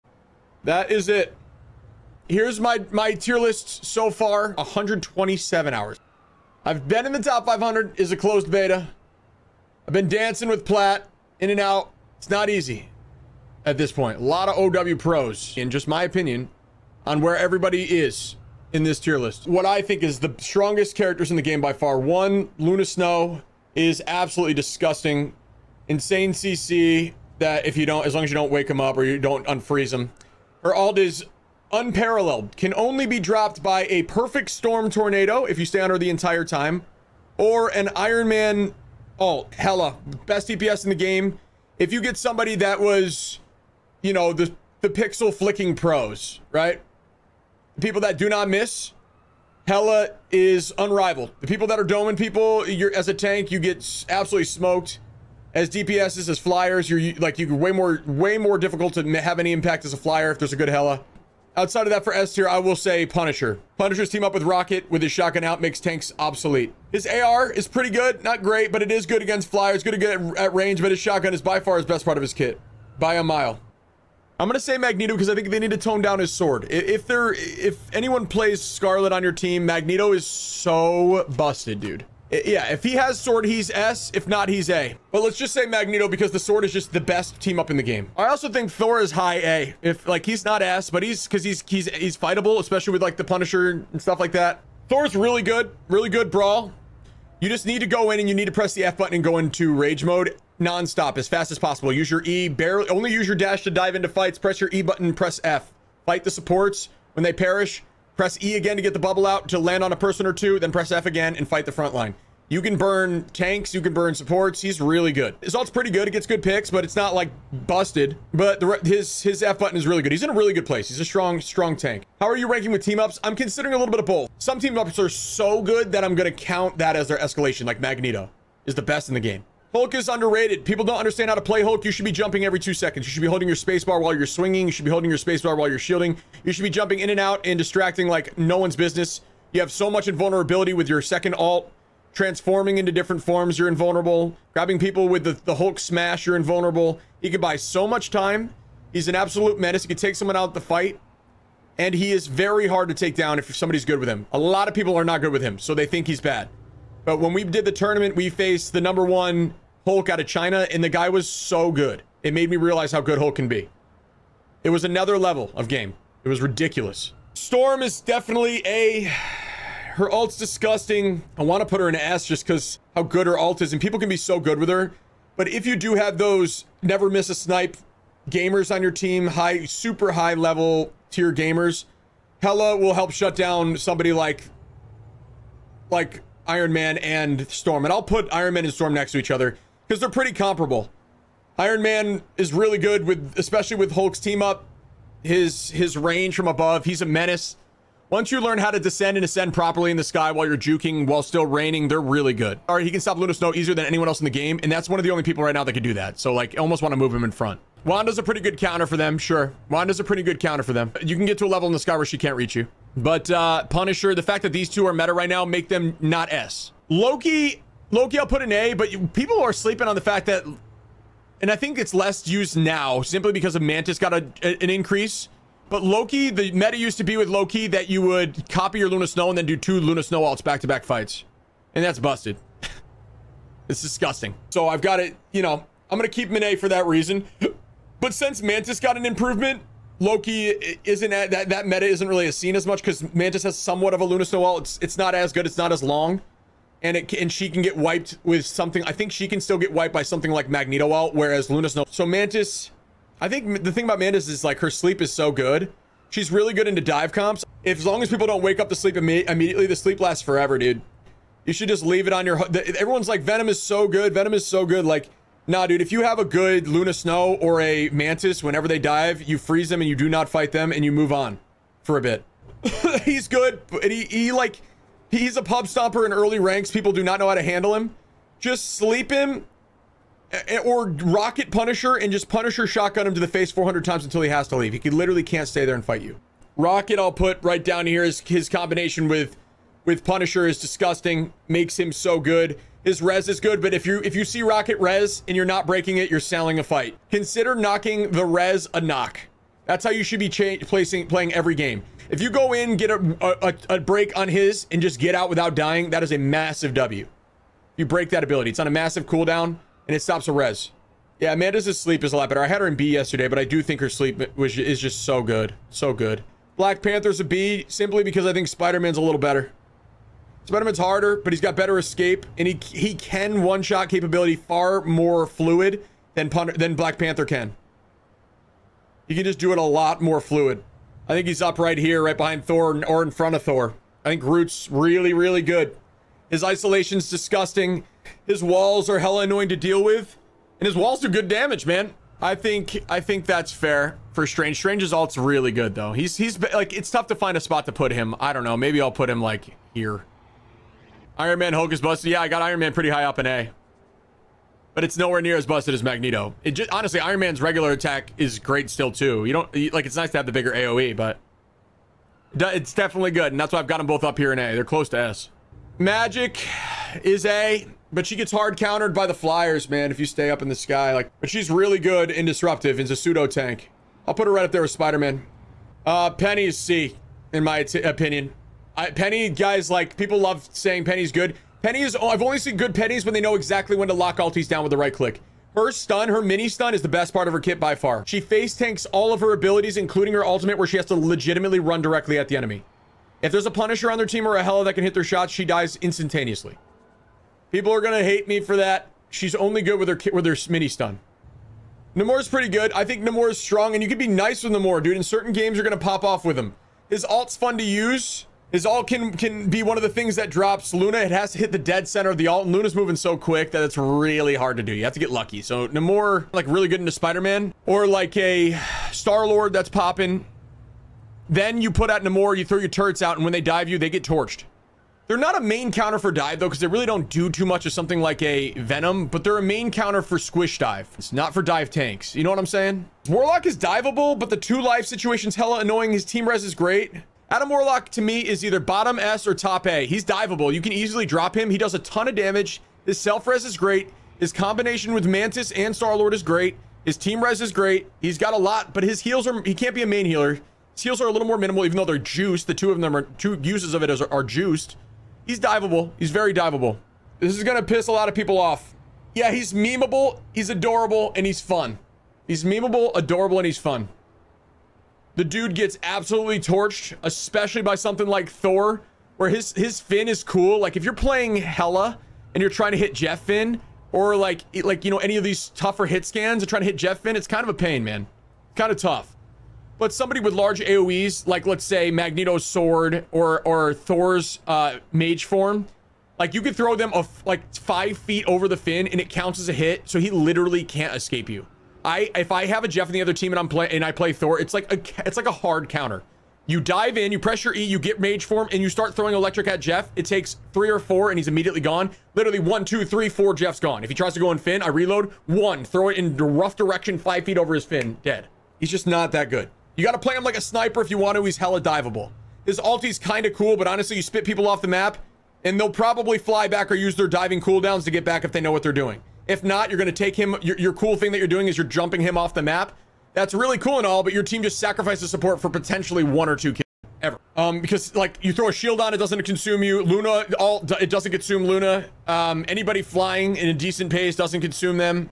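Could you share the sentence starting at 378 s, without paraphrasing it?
I, Peni, guys, like people love saying Peni's good.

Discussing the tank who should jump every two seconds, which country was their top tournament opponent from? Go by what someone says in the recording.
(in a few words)
China.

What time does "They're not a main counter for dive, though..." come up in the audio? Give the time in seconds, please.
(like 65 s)
425 s.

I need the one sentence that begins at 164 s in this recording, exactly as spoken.
It was another level of game.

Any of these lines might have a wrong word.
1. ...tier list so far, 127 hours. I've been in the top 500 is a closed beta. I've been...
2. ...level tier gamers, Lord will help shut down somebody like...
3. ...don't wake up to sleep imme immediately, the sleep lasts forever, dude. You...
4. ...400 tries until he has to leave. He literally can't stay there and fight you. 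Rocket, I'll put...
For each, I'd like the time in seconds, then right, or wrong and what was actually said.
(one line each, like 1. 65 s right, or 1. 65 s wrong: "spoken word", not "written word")
1. 3 s right
2. 180 s wrong: "Hela", not "Lord"
3. 258 s right
4. 283 s wrong: "times", not "tries".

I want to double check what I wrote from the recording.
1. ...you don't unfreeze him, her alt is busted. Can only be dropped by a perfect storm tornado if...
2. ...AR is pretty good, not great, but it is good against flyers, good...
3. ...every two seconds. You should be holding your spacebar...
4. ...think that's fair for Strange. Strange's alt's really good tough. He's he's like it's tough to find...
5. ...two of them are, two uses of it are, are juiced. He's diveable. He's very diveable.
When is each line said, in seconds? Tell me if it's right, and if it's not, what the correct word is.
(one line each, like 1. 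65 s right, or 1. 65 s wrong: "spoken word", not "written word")
1. 29 s wrong: "unparalleled", not "busted"
2. 67 s right
3. 132 s right
4. 343 s wrong: "though", not "tough"
5. 452 s right.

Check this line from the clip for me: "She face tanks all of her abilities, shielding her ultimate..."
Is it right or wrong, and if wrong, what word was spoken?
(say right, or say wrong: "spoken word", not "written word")
wrong: "including", not "shielding".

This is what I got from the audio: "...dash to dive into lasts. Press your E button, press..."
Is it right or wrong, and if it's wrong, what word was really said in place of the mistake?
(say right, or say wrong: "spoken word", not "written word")
wrong: "fights", not "lasts".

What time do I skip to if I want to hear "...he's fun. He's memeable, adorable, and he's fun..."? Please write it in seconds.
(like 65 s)
461 s.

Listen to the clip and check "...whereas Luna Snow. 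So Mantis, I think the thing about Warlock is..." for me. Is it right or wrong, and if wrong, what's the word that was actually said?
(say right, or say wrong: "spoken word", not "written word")
wrong: "Mantis", not "Warlock".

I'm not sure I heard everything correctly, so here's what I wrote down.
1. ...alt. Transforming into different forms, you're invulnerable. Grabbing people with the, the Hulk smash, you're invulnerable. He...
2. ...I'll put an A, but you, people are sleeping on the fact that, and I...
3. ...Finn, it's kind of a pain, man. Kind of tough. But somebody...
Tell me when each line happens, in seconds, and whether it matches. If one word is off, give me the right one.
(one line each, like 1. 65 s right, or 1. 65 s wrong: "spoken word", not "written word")
1. 141 s right
2. 218 s right
3. 477 s right.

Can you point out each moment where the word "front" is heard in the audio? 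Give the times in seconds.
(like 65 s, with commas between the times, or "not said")
111 s, 207 s, 333 s.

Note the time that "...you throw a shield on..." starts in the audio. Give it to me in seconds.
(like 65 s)
528 s.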